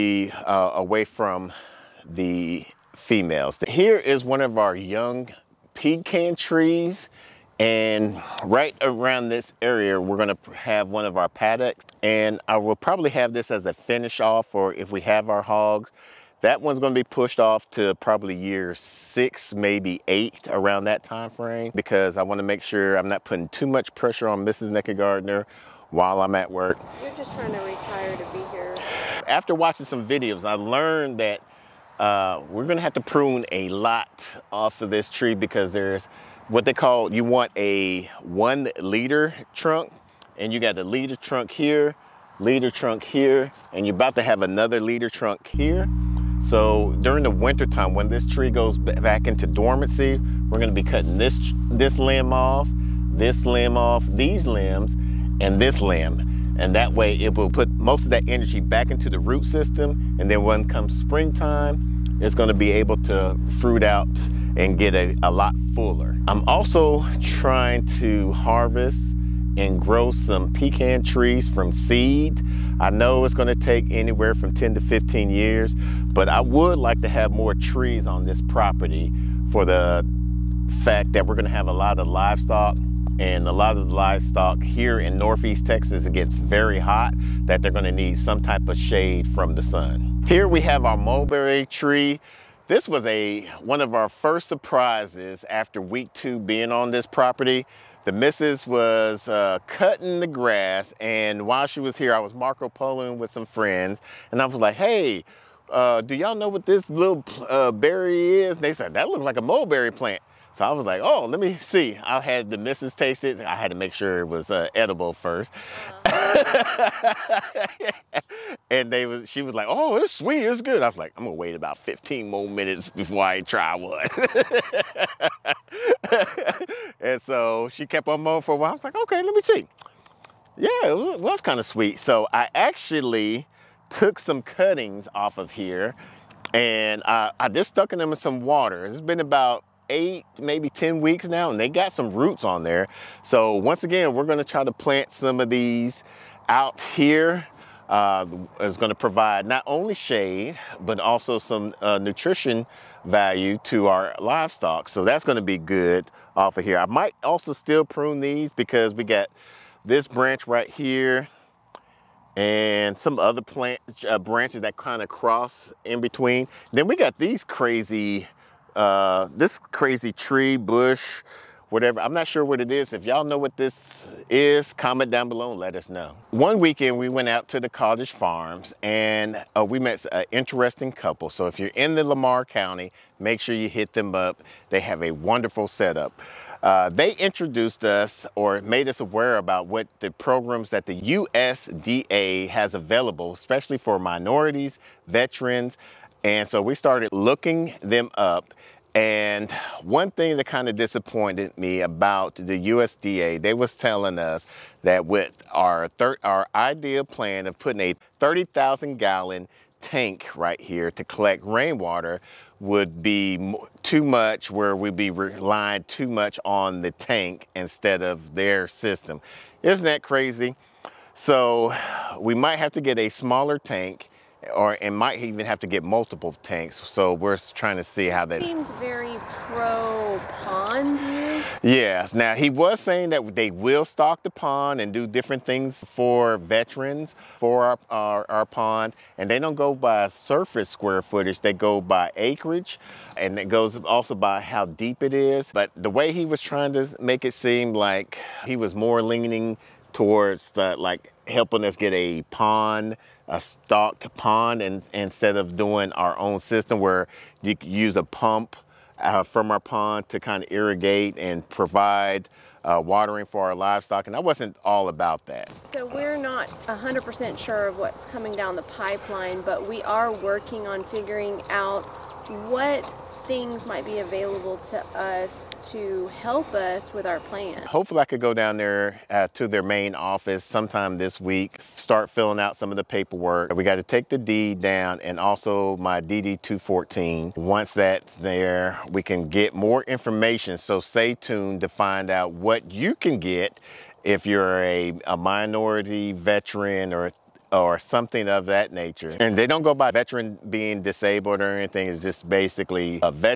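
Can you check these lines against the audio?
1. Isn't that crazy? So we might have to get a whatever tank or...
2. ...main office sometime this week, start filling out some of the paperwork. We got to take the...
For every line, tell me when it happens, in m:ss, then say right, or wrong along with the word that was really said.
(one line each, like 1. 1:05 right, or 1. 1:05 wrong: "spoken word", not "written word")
1. 3:39 wrong: "smaller", not "whatever"
2. 4:39 right.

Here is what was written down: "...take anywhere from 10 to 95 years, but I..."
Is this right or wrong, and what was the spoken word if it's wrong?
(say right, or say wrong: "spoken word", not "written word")
wrong: "15", not "95".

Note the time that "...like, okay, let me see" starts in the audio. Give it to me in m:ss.
2:08.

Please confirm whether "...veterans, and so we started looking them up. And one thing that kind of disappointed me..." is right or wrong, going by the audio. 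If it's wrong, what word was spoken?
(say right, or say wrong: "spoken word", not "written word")
right.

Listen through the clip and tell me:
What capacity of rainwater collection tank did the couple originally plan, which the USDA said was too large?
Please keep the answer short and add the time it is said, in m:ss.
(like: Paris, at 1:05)
30,000 gallons, at 3:28.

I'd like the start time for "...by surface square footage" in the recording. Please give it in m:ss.
3:59.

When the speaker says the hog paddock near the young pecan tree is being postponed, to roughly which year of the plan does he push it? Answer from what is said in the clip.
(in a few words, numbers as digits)
year 6.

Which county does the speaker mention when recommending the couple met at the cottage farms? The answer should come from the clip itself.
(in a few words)
Lamar County.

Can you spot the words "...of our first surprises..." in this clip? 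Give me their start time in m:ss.
1:33.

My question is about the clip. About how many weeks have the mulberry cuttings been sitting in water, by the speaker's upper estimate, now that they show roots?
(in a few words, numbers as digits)
10 weeks.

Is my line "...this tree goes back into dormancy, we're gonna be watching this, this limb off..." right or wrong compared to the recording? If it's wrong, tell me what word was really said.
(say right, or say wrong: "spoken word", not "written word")
wrong: "cutting", not "watching".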